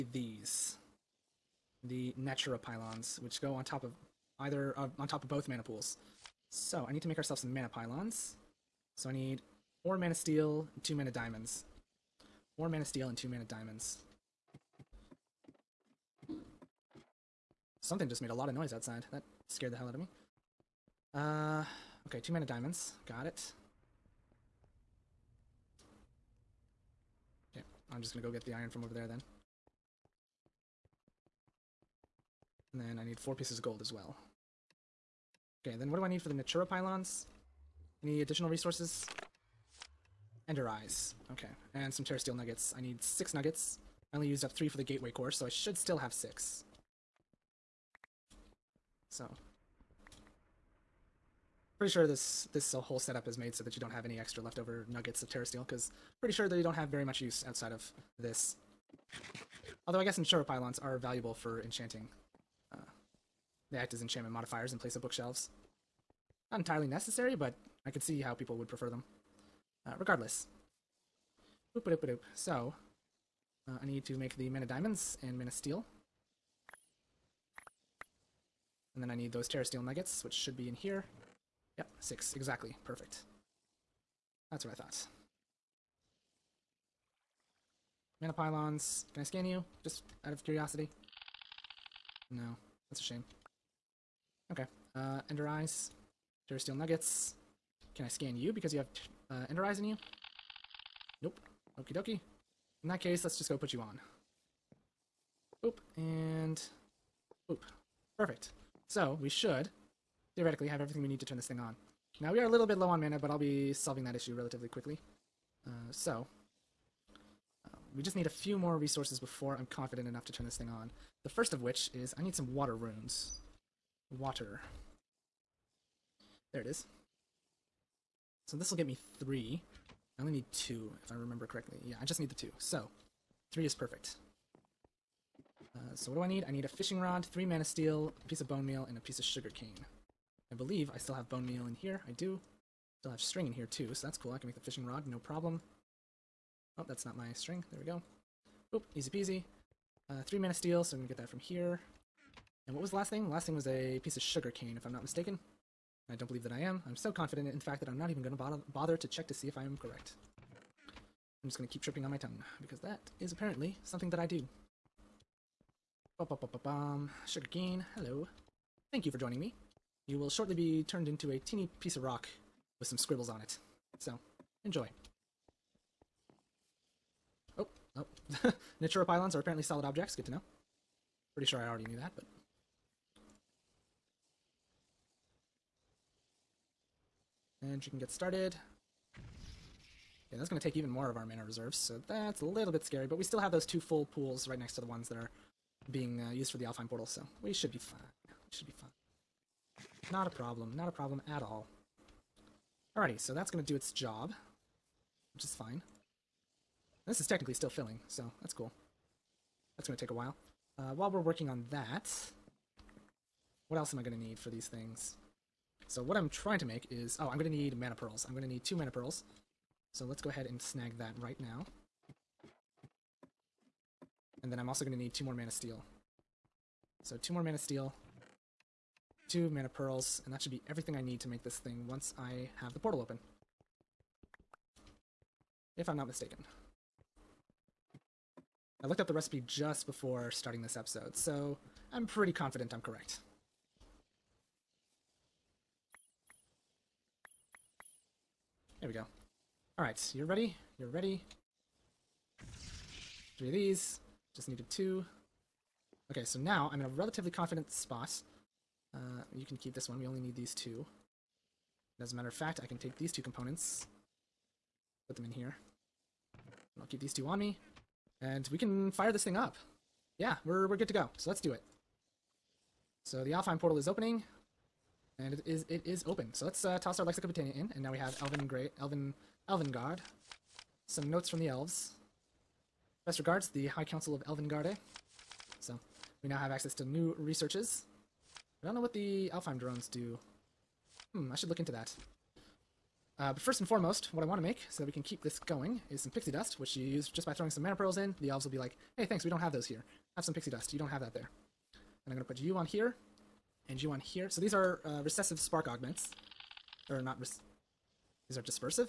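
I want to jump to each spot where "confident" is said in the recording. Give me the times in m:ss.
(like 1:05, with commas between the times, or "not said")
1:59, 2:37, 4:02, 4:17.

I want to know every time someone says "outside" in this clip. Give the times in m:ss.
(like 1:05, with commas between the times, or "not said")
0:18, 0:57.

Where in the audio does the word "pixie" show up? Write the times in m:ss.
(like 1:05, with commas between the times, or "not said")
4:56, 5:00.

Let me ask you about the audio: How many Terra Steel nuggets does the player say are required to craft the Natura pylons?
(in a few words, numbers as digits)
6.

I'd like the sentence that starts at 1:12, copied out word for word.
So, uh, I need to make the mana diamonds and mana steel.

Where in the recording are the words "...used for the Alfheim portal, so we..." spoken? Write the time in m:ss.
3:16.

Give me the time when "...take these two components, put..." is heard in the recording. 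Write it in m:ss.
4:22.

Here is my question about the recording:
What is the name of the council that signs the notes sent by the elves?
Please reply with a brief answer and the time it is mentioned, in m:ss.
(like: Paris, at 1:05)
High Council of Elvengarde, at 4:43.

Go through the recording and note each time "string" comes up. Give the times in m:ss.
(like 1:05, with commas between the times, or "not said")
2:23, 2:27.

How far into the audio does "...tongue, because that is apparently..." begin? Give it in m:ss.
2:42.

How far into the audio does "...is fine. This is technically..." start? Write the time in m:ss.
3:25.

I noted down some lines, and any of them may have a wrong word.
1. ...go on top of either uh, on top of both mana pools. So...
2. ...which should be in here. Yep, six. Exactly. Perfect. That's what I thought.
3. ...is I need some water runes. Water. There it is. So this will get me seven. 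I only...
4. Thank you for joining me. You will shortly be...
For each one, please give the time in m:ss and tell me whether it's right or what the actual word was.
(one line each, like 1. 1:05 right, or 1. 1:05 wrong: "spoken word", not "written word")
1. 0:03 right
2. 1:20 right
3. 2:01 wrong: "three", not "seven"
4. 2:48 right.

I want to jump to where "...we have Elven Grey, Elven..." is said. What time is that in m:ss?
4:37.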